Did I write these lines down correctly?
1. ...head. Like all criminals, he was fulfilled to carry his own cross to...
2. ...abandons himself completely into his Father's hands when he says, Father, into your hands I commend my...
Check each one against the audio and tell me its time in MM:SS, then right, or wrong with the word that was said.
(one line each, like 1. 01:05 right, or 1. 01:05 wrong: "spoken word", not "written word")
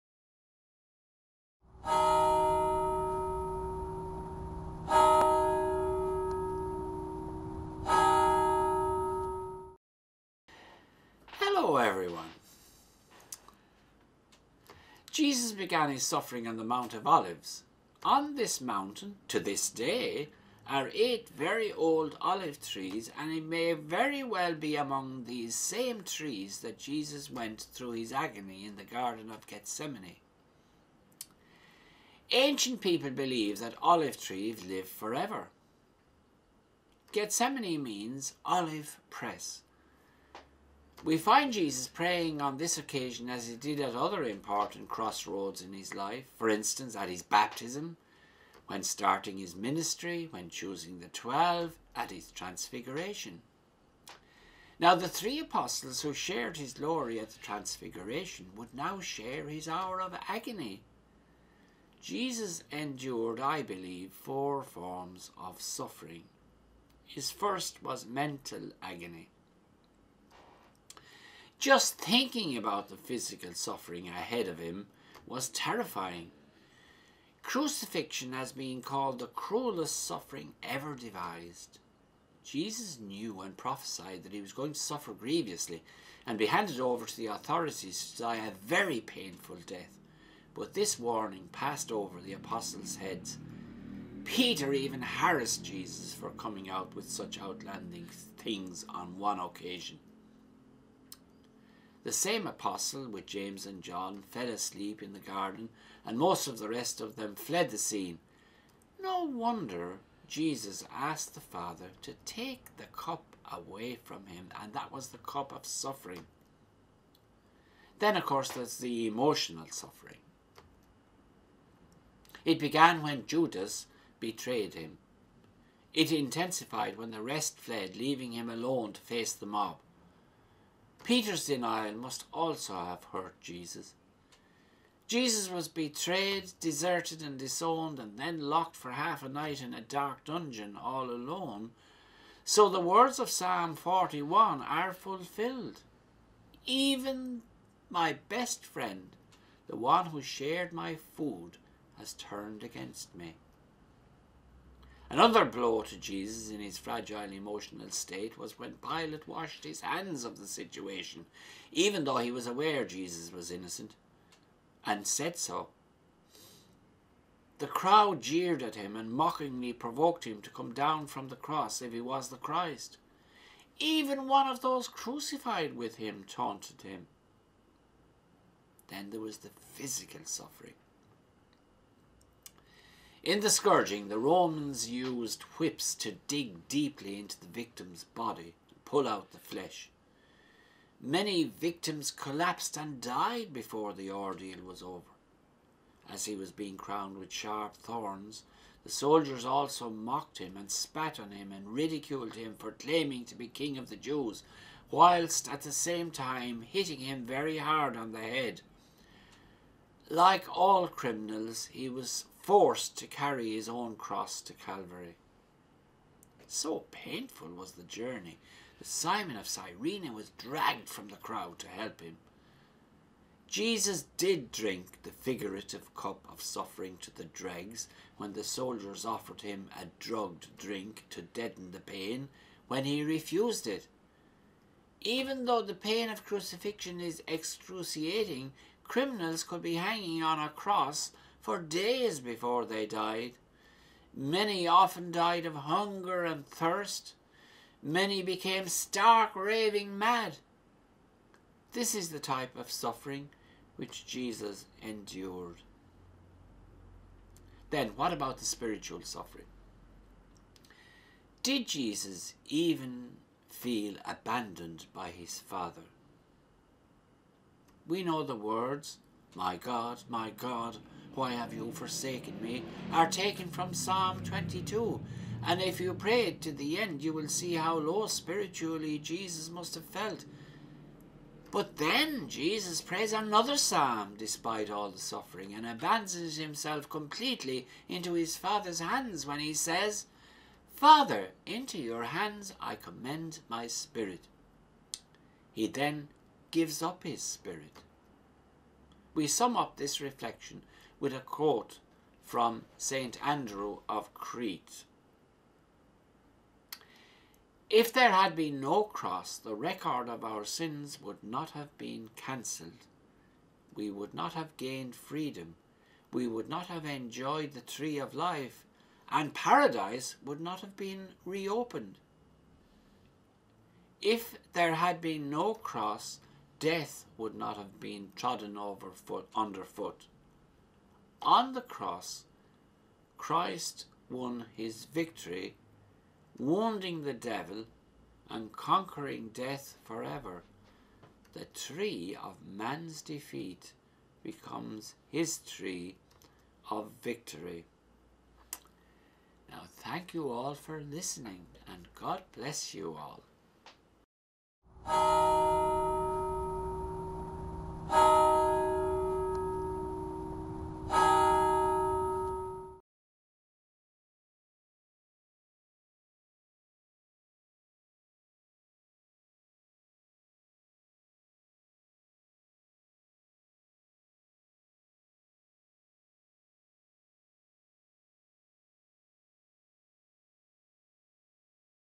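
1. 03:28 wrong: "forced", not "fulfilled"
2. 04:45 right.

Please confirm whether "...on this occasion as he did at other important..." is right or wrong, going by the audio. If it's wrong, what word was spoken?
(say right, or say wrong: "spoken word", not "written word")
right.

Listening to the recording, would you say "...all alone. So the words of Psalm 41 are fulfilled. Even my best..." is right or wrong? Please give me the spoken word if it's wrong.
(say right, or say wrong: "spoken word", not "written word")
right.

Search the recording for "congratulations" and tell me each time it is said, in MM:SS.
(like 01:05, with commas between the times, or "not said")
not said.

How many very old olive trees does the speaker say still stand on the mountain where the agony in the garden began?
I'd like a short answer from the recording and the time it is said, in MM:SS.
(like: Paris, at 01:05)
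8, at 00:20.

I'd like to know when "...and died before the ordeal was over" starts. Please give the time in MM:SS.
03:12.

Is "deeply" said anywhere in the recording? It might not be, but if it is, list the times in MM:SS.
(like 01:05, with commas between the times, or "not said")
03:06.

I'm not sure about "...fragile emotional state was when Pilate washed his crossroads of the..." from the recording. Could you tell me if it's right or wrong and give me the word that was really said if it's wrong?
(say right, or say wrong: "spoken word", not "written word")
wrong: "hands", not "crossroads".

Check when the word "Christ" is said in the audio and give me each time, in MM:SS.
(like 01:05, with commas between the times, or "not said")
02:52, 05:33.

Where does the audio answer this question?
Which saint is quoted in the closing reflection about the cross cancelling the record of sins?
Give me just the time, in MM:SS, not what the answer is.
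05:02.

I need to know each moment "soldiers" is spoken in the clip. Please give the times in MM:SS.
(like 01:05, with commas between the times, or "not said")
03:18, 03:48.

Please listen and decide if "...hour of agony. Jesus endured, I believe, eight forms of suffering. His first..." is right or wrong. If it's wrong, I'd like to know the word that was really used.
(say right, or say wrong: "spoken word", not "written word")
wrong: "four", not "eight".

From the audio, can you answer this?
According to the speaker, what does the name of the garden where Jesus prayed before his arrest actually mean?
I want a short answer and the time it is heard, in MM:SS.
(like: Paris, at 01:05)
Olive press, at 00:38.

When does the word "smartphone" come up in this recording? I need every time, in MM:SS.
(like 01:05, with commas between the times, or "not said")
not said.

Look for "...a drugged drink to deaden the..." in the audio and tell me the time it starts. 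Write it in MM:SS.
03:49.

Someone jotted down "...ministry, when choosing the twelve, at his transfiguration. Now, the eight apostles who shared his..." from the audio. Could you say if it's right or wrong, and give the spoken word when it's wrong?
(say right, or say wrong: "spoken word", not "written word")
wrong: "three", not "eight".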